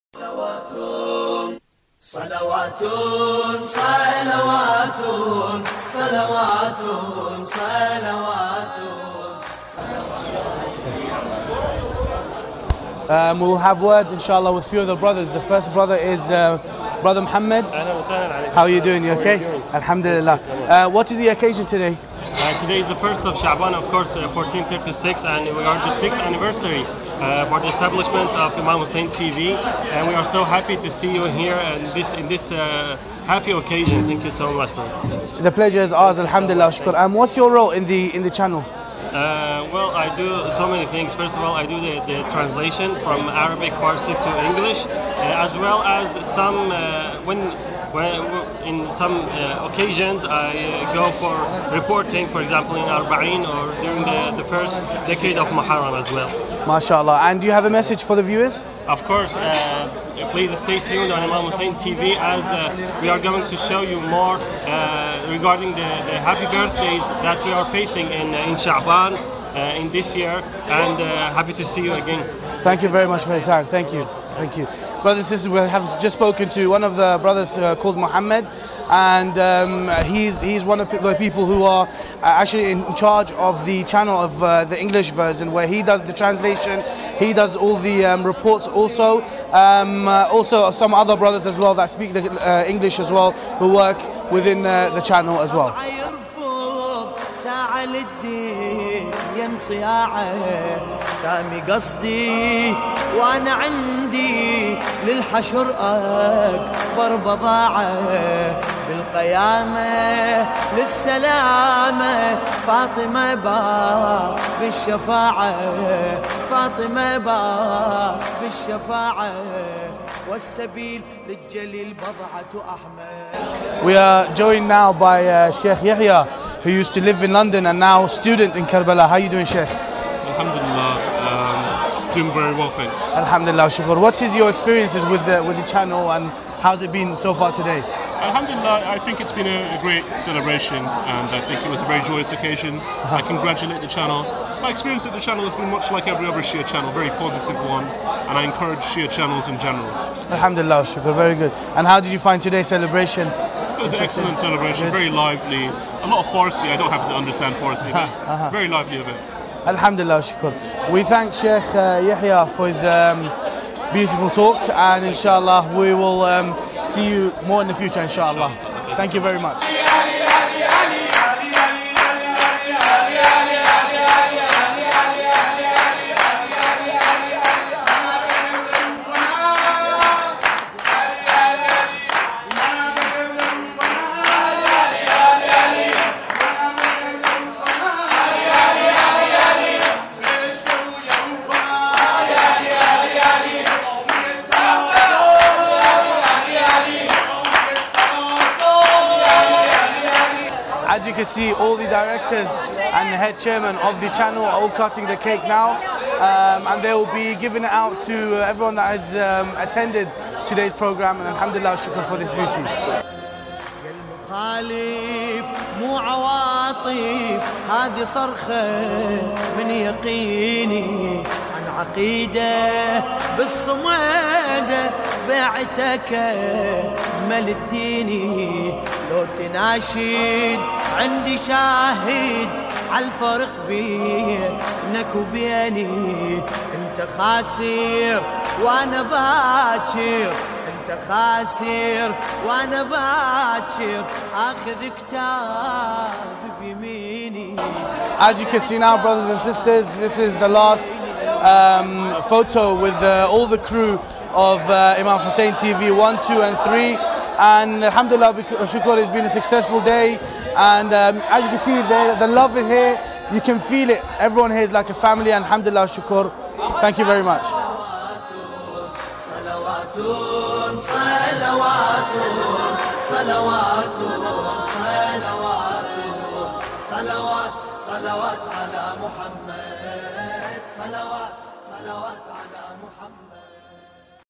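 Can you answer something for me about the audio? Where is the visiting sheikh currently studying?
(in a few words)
Karbala.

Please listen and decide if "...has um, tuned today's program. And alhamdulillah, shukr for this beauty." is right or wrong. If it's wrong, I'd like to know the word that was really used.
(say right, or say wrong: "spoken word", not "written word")
wrong: "attended", not "tuned".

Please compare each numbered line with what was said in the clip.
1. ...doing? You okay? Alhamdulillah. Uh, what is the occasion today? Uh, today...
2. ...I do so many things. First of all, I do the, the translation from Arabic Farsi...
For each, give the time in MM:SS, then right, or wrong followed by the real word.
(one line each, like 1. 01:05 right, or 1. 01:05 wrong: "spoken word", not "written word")
1. 00:18 right
2. 00:39 right.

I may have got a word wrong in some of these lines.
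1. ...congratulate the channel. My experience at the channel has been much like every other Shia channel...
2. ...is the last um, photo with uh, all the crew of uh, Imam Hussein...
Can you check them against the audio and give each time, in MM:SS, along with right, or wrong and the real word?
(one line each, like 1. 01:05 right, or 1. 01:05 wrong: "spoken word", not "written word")
1. 02:23 right
2. 04:10 right.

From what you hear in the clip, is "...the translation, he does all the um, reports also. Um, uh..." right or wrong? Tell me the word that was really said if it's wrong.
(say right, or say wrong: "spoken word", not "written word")
right.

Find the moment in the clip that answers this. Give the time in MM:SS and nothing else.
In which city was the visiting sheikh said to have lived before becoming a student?
02:07.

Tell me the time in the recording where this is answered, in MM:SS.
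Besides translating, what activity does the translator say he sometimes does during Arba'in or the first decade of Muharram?
00:51.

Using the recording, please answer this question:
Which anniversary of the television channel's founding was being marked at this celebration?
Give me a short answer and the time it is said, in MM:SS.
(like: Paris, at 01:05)
sixth, at 00:25.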